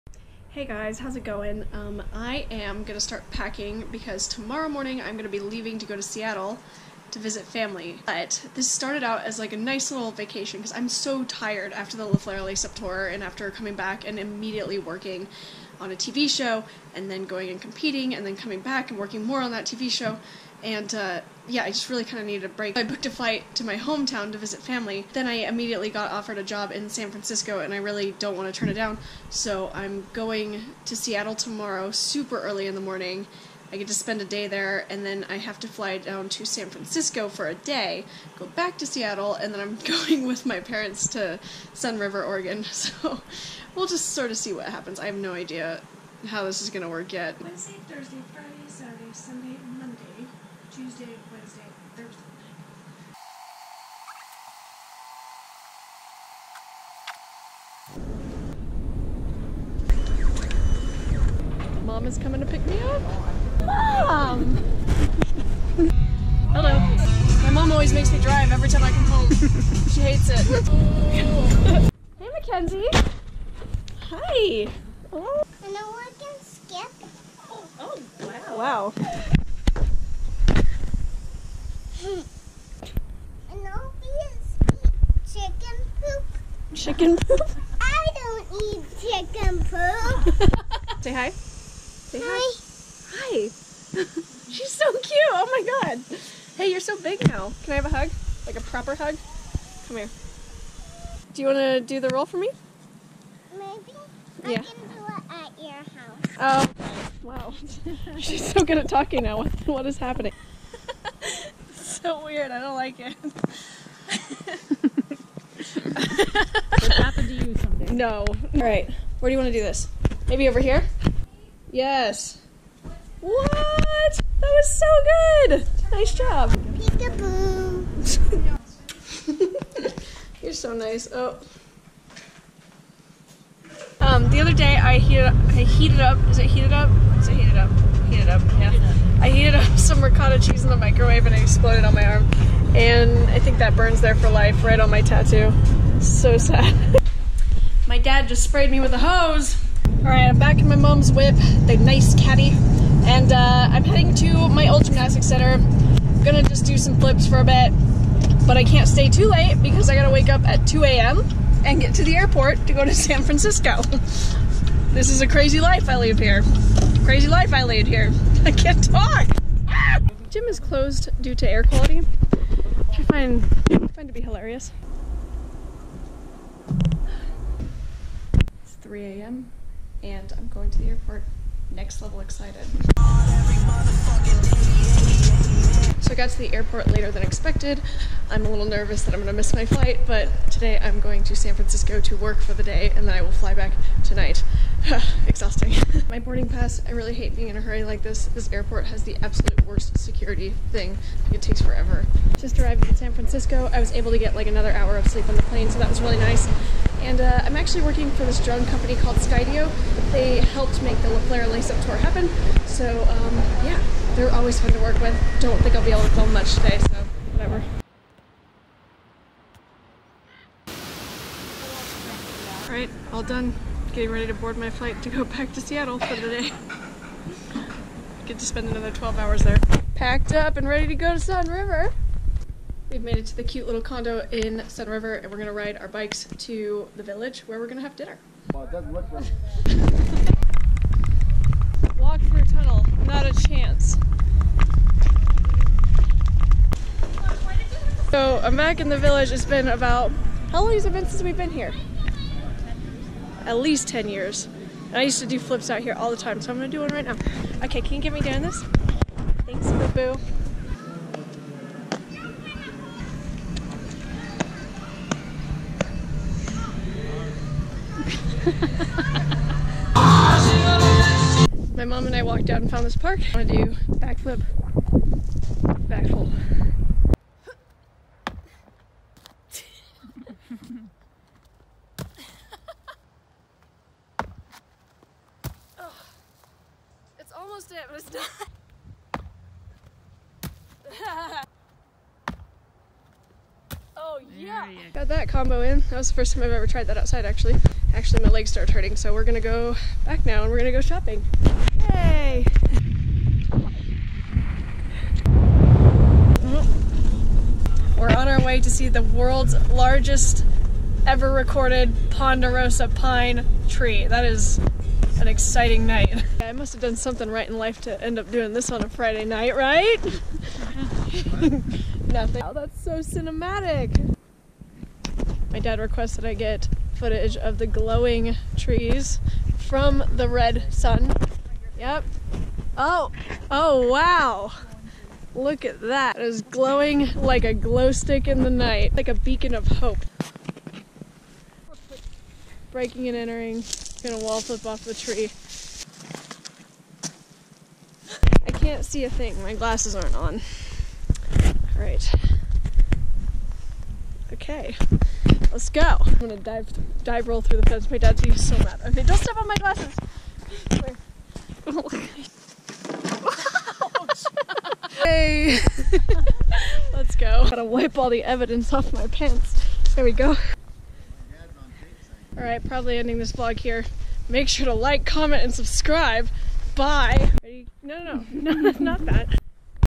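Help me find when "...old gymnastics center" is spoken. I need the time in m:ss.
2:34.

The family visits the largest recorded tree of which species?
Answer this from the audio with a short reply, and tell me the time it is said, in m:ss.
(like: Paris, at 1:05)
ponderosa pine, at 5:12.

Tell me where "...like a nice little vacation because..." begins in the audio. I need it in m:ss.
0:09.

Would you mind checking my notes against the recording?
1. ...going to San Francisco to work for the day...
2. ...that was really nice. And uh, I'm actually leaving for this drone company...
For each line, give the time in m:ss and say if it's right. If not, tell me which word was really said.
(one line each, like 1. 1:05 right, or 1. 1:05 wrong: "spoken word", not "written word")
1. 3:10 right
2. 3:25 wrong: "working", not "leaving".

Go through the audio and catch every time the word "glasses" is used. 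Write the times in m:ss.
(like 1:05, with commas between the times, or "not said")
5:49, 5:59.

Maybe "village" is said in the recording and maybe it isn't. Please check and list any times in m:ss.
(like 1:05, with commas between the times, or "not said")
3:57, 4:08.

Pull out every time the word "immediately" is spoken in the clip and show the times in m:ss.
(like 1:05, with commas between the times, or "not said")
0:14, 0:25.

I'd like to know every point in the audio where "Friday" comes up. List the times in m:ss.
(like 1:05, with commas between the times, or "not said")
0:48, 5:18.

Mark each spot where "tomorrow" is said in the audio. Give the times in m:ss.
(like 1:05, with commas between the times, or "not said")
0:04, 0:31.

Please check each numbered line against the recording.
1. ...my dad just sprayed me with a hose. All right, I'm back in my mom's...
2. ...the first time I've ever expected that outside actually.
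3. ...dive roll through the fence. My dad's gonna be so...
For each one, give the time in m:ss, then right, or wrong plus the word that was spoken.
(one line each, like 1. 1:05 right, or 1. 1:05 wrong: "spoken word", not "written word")
1. 2:27 right
2. 4:56 wrong: "tried", not "expected"
3. 5:57 right.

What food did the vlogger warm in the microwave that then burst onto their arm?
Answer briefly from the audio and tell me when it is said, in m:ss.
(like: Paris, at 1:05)
ricotta cheese, at 2:20.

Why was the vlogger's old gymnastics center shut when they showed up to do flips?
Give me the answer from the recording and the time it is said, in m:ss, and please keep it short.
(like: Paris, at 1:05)
air quality, at 2:51.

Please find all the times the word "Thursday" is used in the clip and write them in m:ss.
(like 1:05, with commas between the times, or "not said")
0:47, 0:51.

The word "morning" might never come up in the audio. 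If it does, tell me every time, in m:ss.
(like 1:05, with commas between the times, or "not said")
0:04, 0:32.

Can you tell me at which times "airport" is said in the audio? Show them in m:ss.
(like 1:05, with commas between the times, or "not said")
2:42, 3:00, 3:06, 3:18.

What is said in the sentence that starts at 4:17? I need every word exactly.
Okay, can you get me down this?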